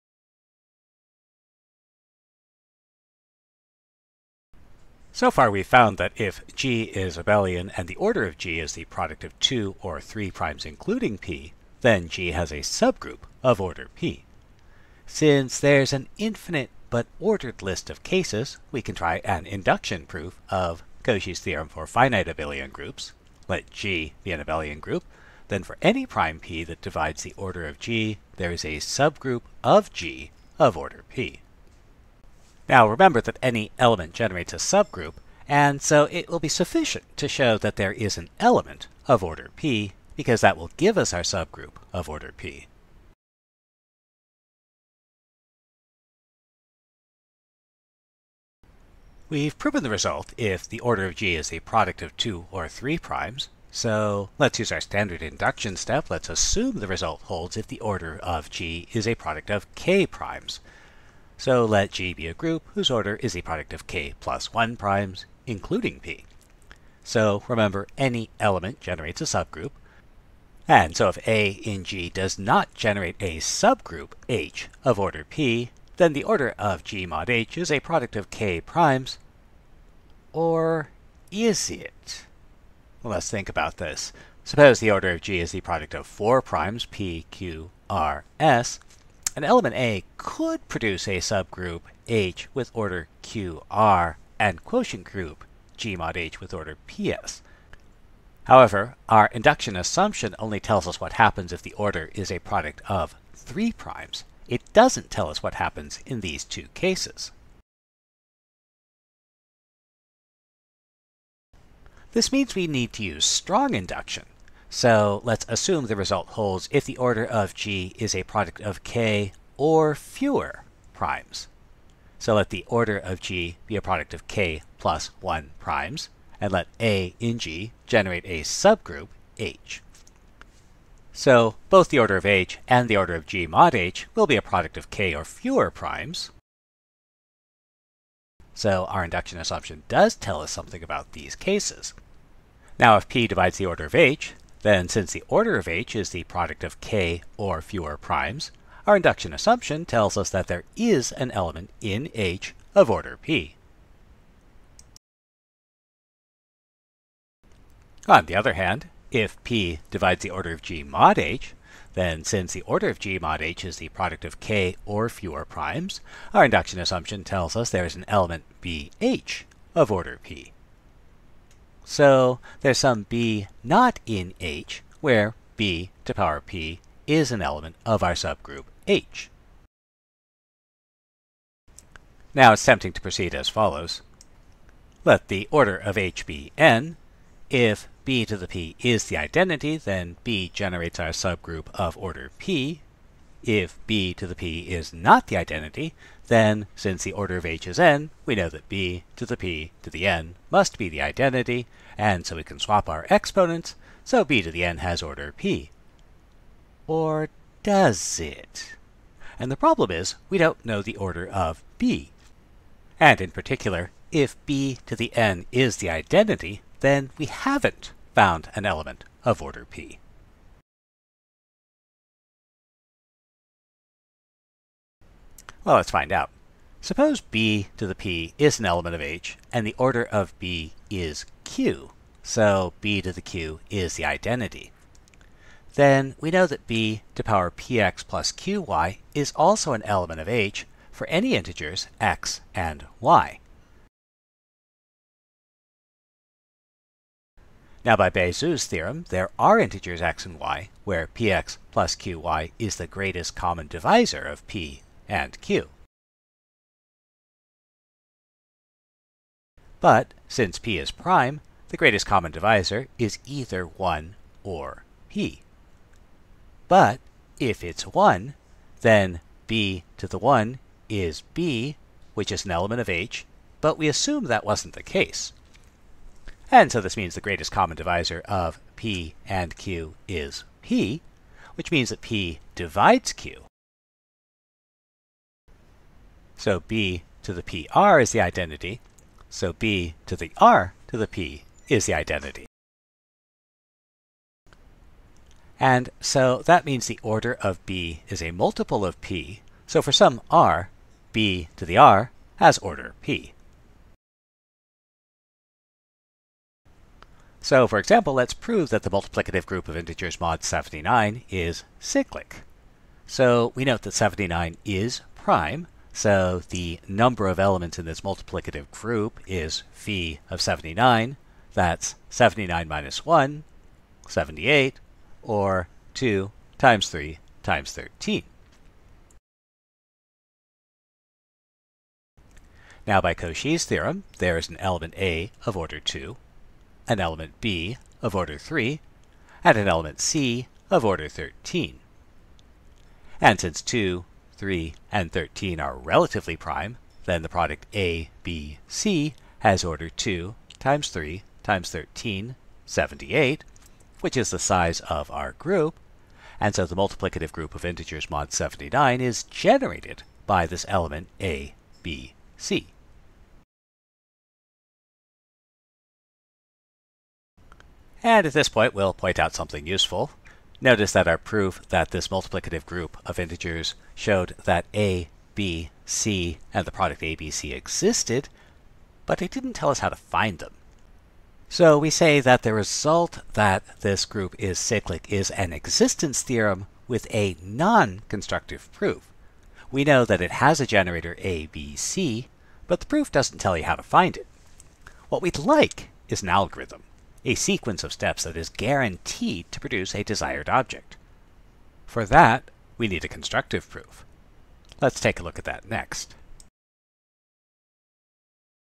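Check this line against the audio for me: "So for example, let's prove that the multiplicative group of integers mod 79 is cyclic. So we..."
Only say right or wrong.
right.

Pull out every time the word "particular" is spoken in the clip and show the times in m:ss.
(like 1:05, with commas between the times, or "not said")
3:33.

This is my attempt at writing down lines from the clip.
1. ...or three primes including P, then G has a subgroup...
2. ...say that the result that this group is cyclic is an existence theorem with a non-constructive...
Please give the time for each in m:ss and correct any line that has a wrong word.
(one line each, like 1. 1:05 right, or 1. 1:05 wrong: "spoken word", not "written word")
1. 0:09 right
2. 6:21 right.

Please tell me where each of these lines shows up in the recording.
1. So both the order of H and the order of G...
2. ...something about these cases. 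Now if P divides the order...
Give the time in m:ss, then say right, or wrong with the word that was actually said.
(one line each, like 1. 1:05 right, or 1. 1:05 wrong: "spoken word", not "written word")
1. 2:11 right
2. 2:20 right.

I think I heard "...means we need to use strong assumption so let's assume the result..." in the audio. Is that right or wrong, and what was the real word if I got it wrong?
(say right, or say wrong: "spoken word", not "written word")
wrong: "induction", not "assumption".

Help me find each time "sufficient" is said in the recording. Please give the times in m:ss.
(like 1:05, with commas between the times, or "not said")
0:36.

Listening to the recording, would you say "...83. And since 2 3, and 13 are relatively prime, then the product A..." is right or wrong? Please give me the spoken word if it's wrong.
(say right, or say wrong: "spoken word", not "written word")
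wrong: "13", not "83".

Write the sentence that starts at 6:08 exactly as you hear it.
And at this point we'll point out something useful.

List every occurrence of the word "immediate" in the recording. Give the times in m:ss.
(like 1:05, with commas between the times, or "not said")
not said.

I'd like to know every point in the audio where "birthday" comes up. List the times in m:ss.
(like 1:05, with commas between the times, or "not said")
not said.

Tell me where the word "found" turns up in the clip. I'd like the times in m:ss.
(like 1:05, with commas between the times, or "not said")
0:05, 3:38.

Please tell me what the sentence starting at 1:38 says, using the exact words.
However, our induction assumption only tells us what happens if the order is a product of three primes.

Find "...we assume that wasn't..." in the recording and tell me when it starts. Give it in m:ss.
4:33.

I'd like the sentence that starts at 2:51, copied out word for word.
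So there's some b not in H, where b to power p is an element of our subgroup H.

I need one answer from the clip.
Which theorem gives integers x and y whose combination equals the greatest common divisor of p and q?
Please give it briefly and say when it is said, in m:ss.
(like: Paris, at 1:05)
Bezout's theorem, at 4:08.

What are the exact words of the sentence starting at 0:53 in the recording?
So let's use our standard induction step.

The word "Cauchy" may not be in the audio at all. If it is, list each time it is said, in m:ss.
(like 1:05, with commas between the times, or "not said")
0:21, 5:33.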